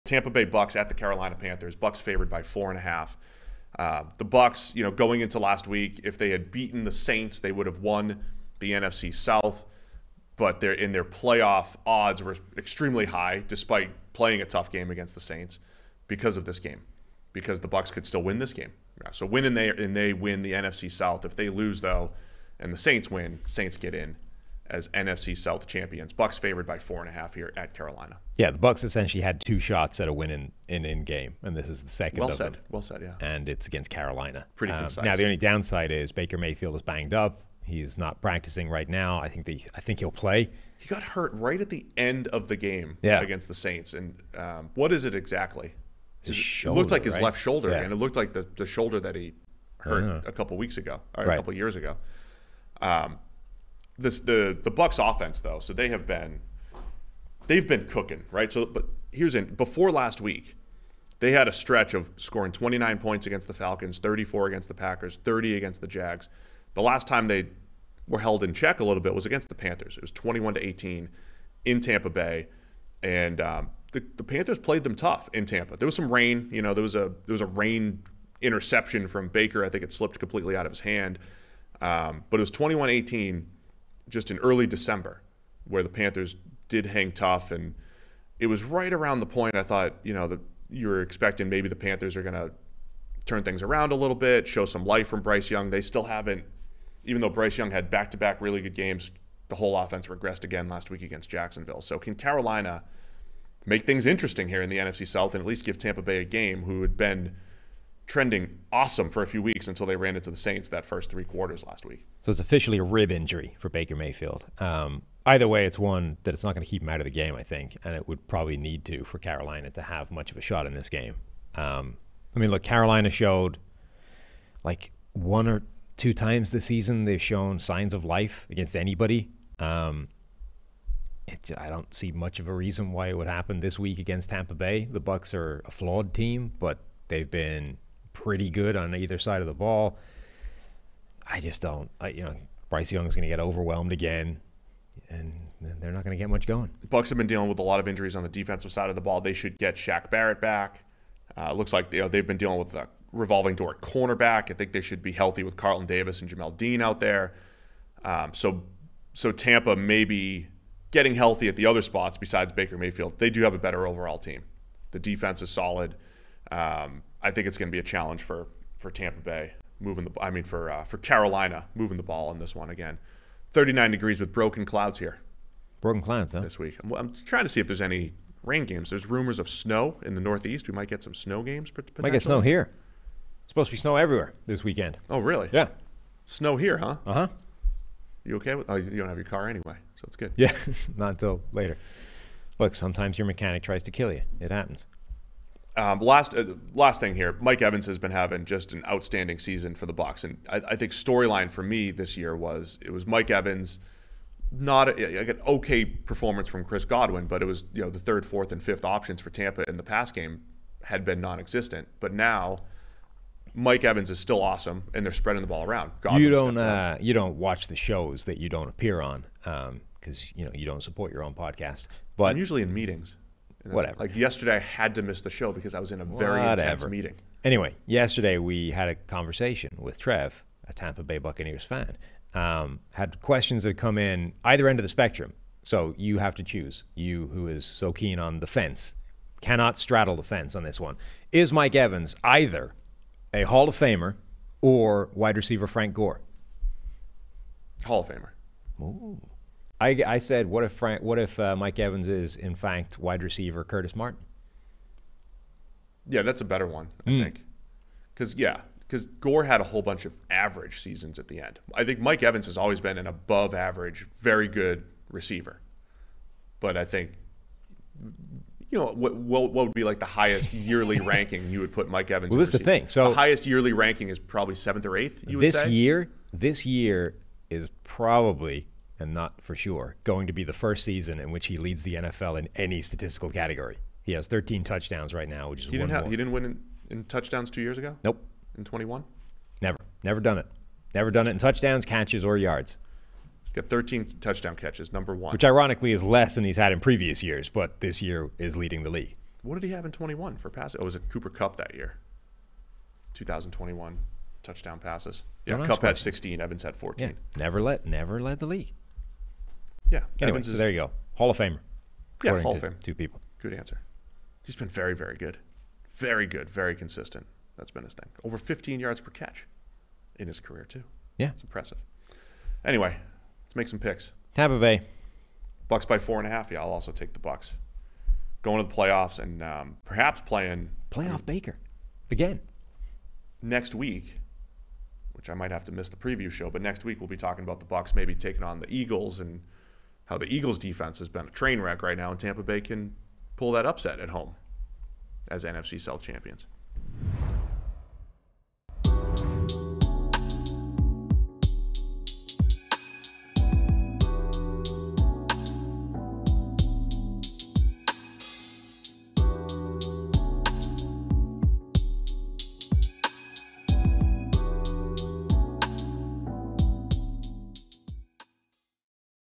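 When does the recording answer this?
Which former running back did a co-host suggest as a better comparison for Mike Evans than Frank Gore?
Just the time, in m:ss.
4:13.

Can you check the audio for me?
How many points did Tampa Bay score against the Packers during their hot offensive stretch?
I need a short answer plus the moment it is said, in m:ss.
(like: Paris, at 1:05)
34, at 1:03.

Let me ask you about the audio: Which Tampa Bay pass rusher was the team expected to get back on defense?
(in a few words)
Shaq Barrett.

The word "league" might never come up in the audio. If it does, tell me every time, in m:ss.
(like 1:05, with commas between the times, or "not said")
4:58, 5:08.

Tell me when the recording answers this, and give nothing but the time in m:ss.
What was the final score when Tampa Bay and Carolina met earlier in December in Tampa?
1:10.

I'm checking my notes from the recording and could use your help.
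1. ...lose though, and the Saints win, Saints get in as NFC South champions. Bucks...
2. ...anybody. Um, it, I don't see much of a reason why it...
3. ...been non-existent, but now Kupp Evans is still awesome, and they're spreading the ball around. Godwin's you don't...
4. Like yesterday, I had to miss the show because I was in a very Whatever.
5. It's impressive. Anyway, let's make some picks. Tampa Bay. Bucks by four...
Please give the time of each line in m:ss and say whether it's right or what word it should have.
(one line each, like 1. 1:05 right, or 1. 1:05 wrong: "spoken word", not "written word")
1. 0:21 right
2. 2:08 right
3. 3:31 wrong: "Mike", not "Kupp"
4. 3:43 right
5. 5:21 right.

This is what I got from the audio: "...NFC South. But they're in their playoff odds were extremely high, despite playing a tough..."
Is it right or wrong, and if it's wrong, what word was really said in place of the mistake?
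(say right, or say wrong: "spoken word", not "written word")
right.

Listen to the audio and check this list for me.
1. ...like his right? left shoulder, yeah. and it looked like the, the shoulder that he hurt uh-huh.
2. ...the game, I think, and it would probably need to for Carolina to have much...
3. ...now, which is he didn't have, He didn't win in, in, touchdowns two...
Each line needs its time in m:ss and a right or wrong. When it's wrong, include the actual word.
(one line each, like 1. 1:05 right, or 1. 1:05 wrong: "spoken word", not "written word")
1. 0:46 right
2. 1:57 right
3. 4:45 right.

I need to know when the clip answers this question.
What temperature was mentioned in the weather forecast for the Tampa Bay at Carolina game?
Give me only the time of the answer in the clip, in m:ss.
2:53.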